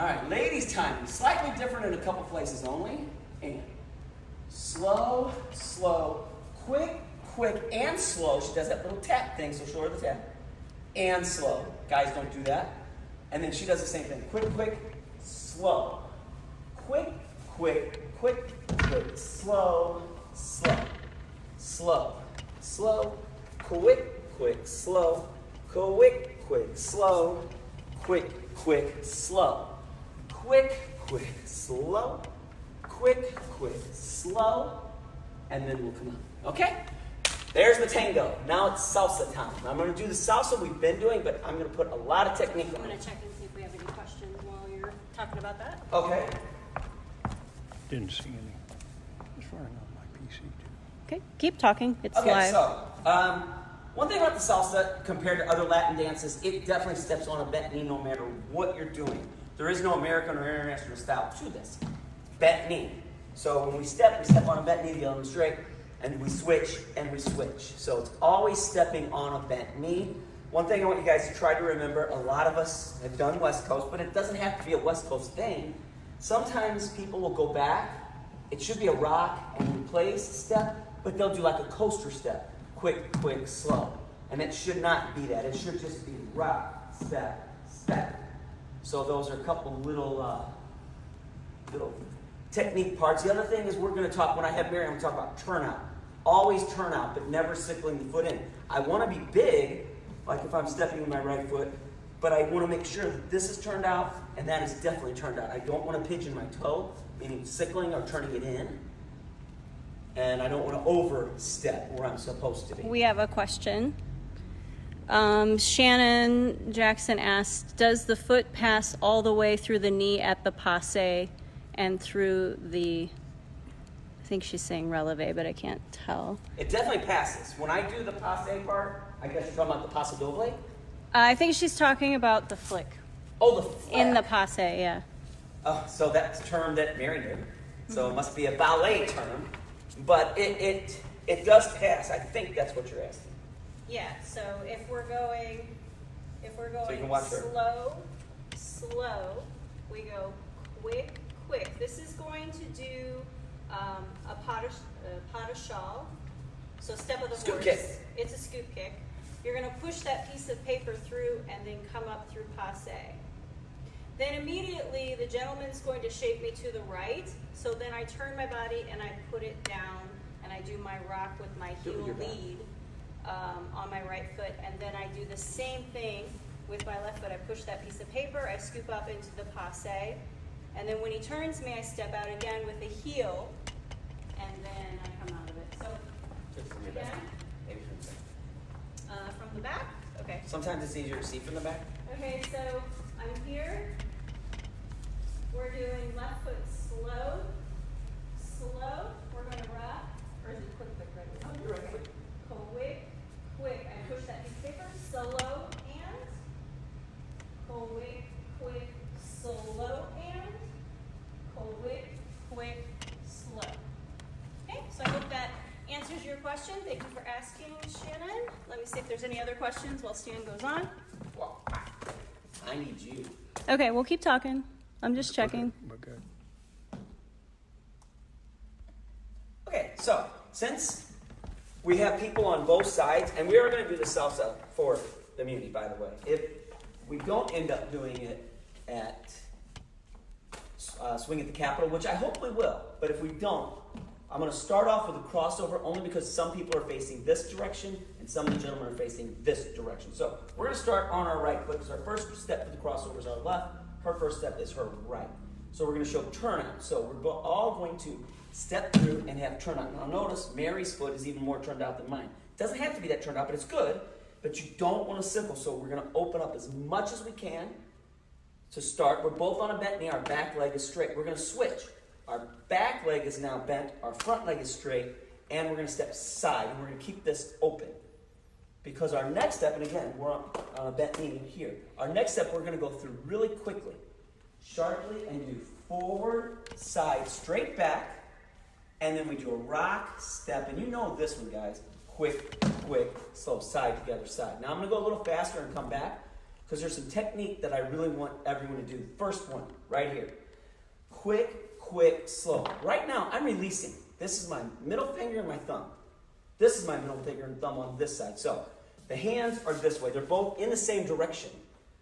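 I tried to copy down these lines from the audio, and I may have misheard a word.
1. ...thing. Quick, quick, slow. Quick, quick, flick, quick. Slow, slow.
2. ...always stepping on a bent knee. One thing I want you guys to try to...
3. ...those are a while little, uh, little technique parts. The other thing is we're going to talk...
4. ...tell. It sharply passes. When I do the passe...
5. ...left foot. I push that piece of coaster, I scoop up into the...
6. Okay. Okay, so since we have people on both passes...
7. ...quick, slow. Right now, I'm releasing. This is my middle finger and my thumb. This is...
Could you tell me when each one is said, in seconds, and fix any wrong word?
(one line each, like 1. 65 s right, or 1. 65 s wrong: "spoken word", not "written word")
1. 14 s wrong: "quick", not "flick"
2. 68 s right
3. 89 s wrong: "couple", not "while"
4. 125 s wrong: "definitely", not "sharply"
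5. 177 s wrong: "paper", not "coaster"
6. 225 s wrong: "sides", not "passes"
7. 301 s right.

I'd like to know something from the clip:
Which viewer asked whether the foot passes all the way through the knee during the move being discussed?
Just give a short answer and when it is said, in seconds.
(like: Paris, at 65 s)
Shannon Jackson, at 115 s.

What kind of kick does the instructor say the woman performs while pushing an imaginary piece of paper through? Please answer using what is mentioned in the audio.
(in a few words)
scoop kick.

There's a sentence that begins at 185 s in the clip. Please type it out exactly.
So, again, Maybe from the back.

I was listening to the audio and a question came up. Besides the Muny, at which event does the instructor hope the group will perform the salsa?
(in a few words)
Swing at the Capitol.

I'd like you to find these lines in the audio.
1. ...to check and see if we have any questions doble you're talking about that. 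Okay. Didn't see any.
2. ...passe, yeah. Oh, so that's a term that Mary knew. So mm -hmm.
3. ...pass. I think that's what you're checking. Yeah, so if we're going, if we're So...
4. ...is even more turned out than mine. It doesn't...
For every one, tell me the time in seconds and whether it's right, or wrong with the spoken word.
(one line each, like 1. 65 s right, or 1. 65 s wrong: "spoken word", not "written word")
1. 42 s wrong: "while", not "doble"
2. 134 s right
3. 141 s wrong: "asking", not "checking"
4. 261 s right.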